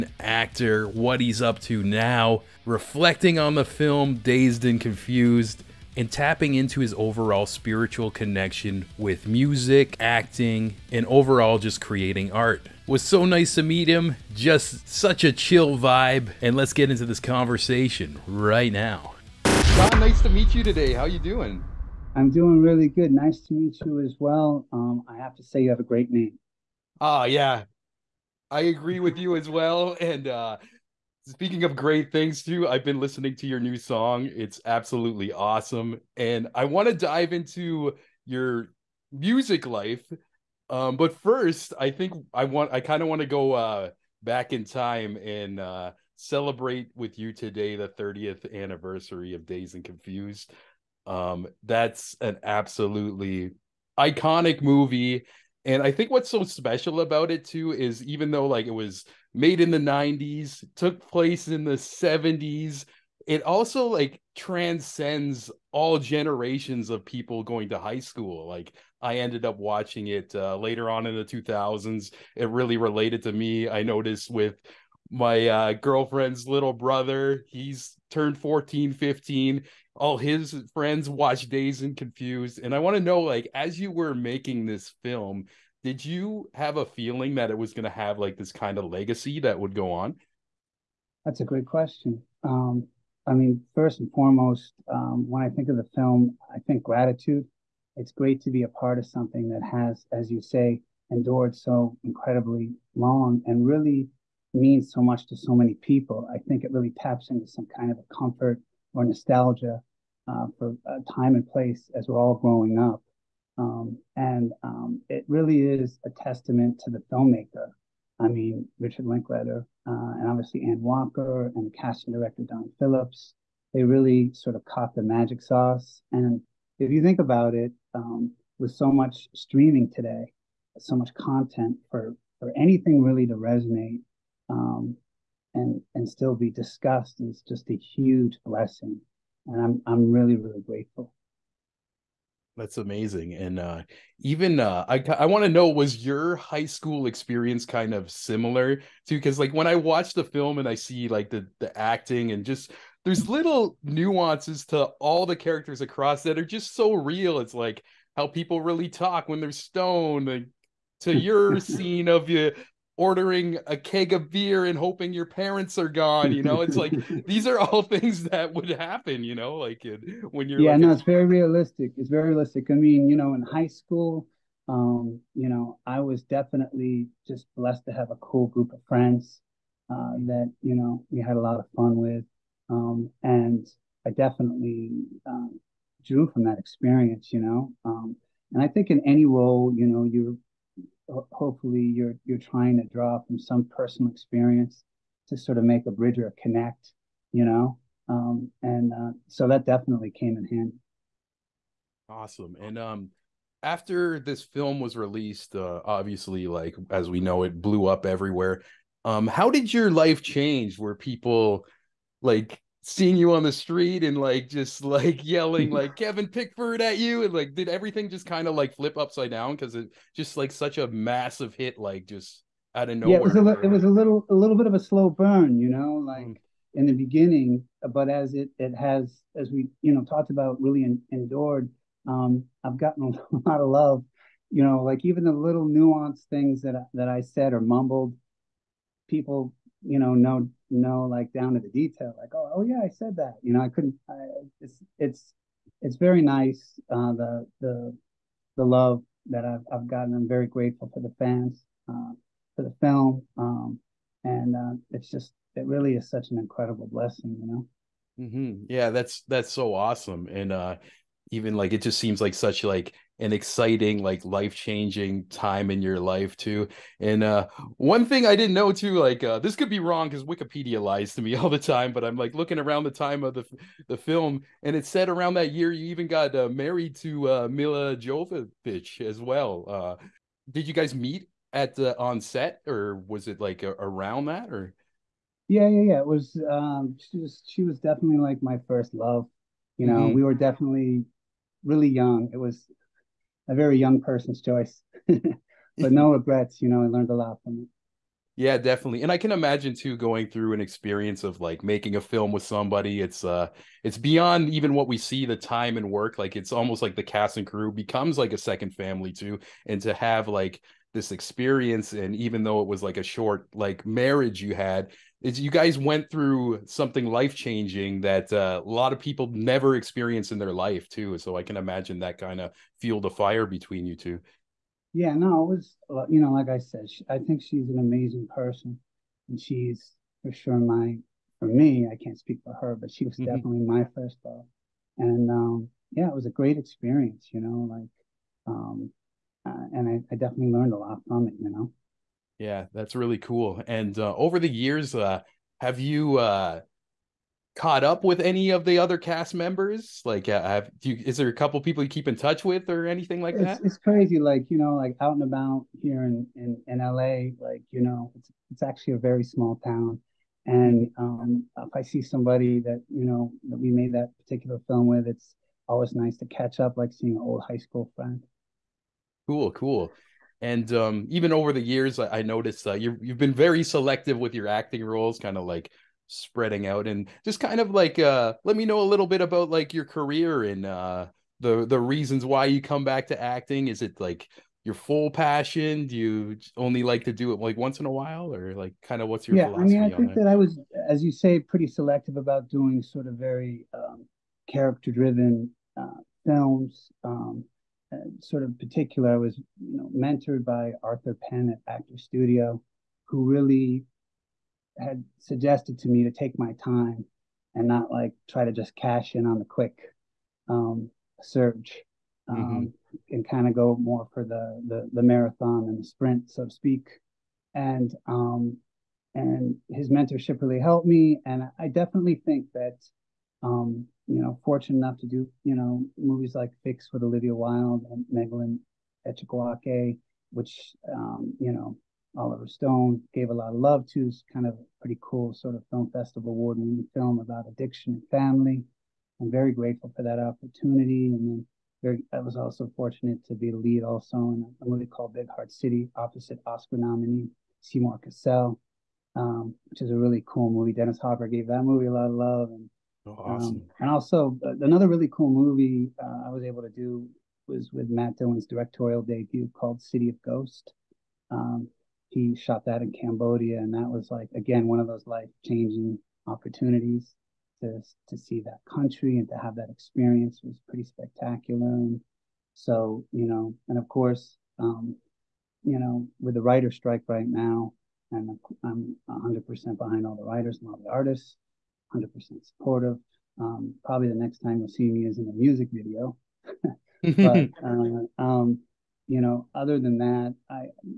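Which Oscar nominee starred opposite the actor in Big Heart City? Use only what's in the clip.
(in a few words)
Seymour Cassel.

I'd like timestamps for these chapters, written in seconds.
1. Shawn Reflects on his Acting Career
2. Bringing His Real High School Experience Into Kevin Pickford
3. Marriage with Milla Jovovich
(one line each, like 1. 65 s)
1. 367 s
2. 140 s
3. 259 s.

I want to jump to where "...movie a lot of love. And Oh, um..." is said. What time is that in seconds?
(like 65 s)
451 s.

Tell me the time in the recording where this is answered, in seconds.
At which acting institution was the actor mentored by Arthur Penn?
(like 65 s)
401 s.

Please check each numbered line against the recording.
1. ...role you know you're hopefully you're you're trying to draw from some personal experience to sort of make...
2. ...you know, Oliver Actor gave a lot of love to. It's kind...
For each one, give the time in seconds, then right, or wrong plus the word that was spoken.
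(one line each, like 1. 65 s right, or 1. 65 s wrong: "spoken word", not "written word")
1. 189 s right
2. 431 s wrong: "Stone", not "Actor".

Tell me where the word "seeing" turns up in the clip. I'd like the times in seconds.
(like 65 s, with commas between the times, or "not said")
212 s, 366 s.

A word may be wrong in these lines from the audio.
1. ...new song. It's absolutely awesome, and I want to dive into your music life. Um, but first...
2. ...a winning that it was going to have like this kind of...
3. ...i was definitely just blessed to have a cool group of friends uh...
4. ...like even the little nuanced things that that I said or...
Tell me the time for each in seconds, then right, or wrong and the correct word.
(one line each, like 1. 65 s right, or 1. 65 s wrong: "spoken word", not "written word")
1. 33 s right
2. 86 s wrong: "feeling", not "winning"
3. 175 s right
4. 234 s right.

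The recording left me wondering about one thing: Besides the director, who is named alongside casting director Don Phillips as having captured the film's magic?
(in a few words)
Anne Walker.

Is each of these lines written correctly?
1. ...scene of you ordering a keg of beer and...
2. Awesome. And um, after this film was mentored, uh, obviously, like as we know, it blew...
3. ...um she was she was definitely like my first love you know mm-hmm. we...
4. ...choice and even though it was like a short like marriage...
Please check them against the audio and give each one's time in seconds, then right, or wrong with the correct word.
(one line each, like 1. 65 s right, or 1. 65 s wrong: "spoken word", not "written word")
1. 161 s right
2. 202 s wrong: "released", not "mentored"
3. 286 s right
4. 311 s wrong: "experience", not "choice".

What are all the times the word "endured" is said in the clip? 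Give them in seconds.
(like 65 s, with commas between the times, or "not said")
101 s, 231 s.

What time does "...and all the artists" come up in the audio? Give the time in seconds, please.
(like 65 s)
480 s.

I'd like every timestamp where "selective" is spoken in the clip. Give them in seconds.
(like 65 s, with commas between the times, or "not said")
373 s, 391 s.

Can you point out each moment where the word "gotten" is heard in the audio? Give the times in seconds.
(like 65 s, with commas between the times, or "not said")
232 s, 249 s.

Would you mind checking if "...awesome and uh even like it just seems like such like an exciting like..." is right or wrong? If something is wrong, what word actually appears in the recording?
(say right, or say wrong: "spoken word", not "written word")
right.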